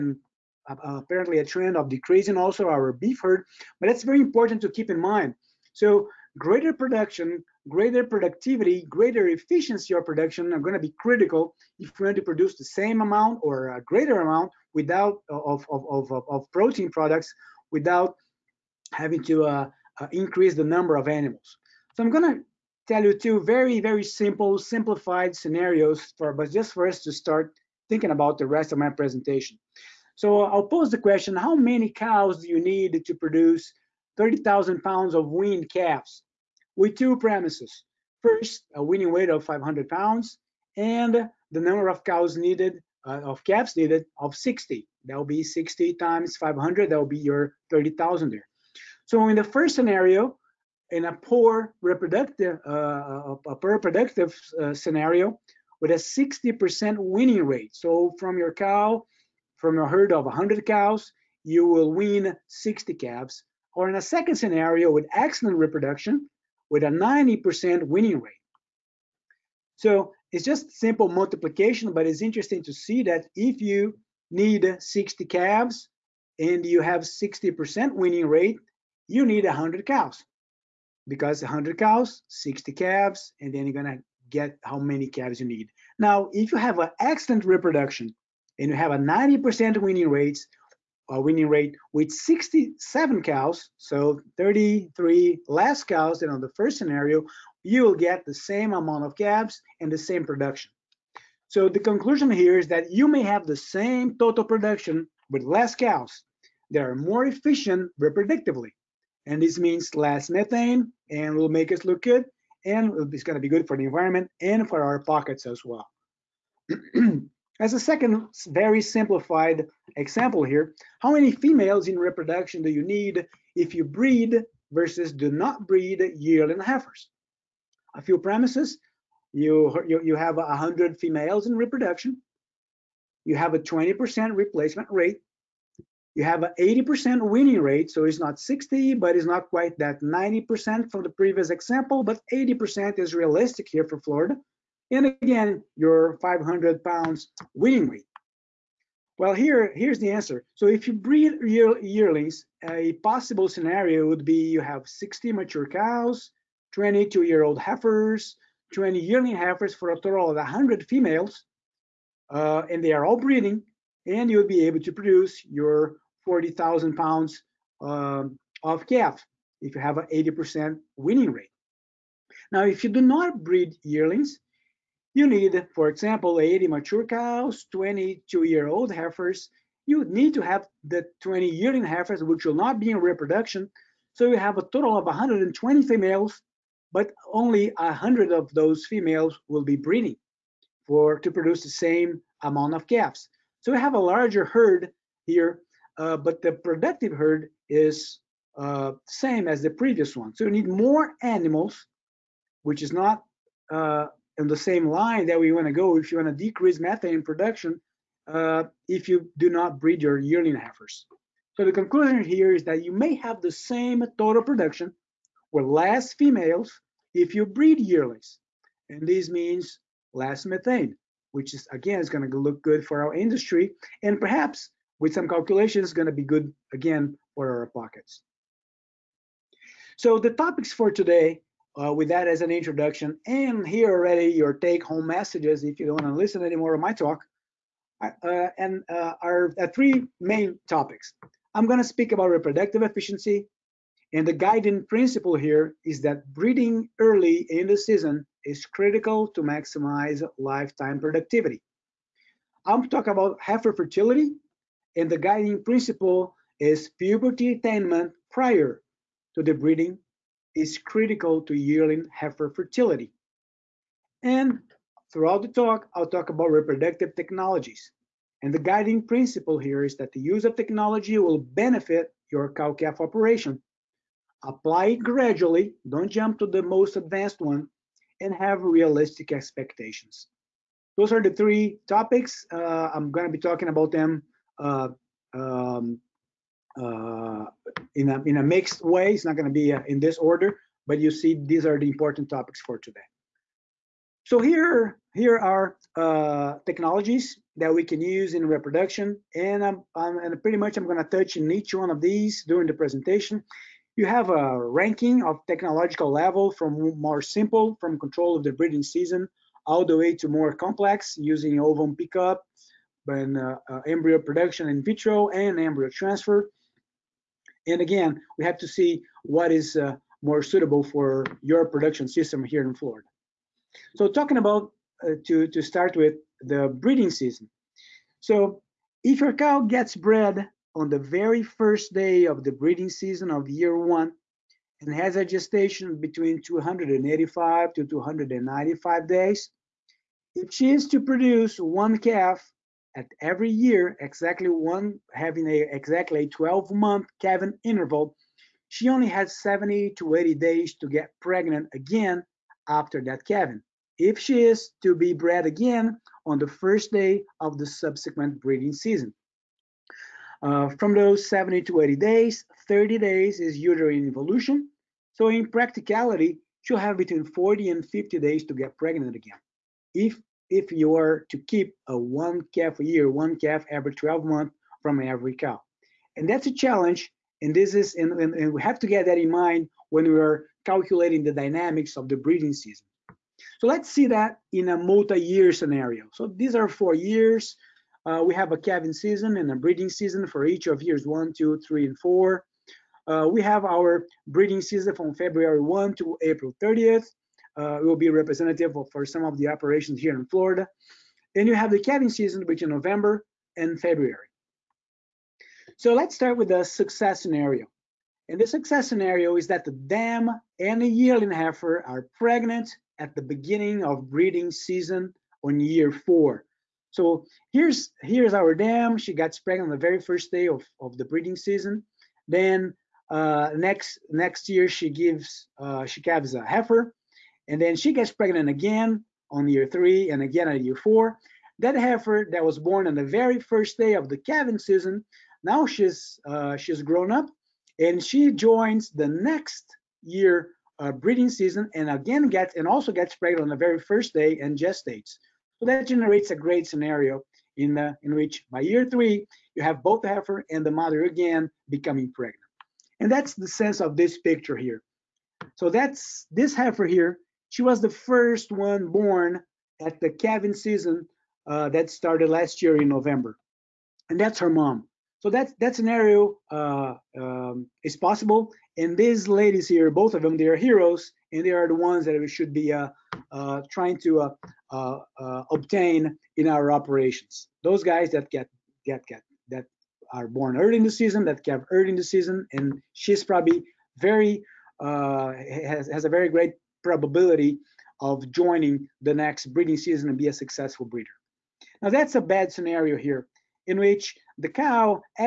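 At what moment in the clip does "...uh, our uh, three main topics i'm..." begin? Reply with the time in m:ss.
3:58.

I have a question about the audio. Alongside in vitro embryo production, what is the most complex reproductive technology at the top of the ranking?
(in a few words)
ovum pickup.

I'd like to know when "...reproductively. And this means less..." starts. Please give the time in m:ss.
1:48.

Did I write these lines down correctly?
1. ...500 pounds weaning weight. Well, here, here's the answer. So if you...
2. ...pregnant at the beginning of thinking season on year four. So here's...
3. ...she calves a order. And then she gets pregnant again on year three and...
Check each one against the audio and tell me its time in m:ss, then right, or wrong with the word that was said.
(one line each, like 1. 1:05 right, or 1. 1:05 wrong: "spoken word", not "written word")
1. 2:26 right
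2. 6:52 wrong: "breeding", not "thinking"
3. 7:05 wrong: "heifer", not "order".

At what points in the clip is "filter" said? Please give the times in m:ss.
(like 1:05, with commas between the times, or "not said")
not said.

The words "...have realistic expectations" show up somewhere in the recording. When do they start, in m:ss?
4:38.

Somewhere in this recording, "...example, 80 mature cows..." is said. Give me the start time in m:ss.
2:55.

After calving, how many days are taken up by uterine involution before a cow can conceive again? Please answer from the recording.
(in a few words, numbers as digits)
30.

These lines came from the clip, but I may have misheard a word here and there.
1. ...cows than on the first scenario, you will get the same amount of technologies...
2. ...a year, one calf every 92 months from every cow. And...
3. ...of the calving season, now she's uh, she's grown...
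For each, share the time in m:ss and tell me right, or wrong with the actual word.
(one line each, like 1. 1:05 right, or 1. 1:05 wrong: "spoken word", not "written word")
1. 1:35 wrong: "calves", not "technologies"
2. 6:12 wrong: "12", not "92"
3. 7:13 right.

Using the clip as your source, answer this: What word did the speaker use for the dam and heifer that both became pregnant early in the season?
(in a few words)
heroes.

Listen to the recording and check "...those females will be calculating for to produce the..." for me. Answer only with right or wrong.
wrong.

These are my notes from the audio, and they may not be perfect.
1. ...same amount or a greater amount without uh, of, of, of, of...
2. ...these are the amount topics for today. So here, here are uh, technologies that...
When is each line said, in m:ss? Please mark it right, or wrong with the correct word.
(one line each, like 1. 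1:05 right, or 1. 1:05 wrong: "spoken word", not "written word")
1. 0:12 right
2. 4:51 wrong: "important", not "amount".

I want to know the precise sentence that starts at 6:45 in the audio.
So let's start with the success scenario.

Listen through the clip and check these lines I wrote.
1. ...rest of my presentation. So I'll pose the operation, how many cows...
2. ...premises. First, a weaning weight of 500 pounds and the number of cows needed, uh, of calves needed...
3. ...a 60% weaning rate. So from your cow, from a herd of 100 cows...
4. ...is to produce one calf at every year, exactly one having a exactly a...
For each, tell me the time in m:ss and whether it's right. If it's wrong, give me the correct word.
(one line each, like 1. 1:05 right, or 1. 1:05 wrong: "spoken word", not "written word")
1. 0:28 wrong: "question", not "operation"
2. 0:37 right
3. 0:55 right
4. 5:40 right.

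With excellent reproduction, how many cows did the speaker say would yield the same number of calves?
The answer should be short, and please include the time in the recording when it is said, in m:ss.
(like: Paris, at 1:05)
67, at 1:32.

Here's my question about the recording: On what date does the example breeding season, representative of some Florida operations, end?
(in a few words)
April 30.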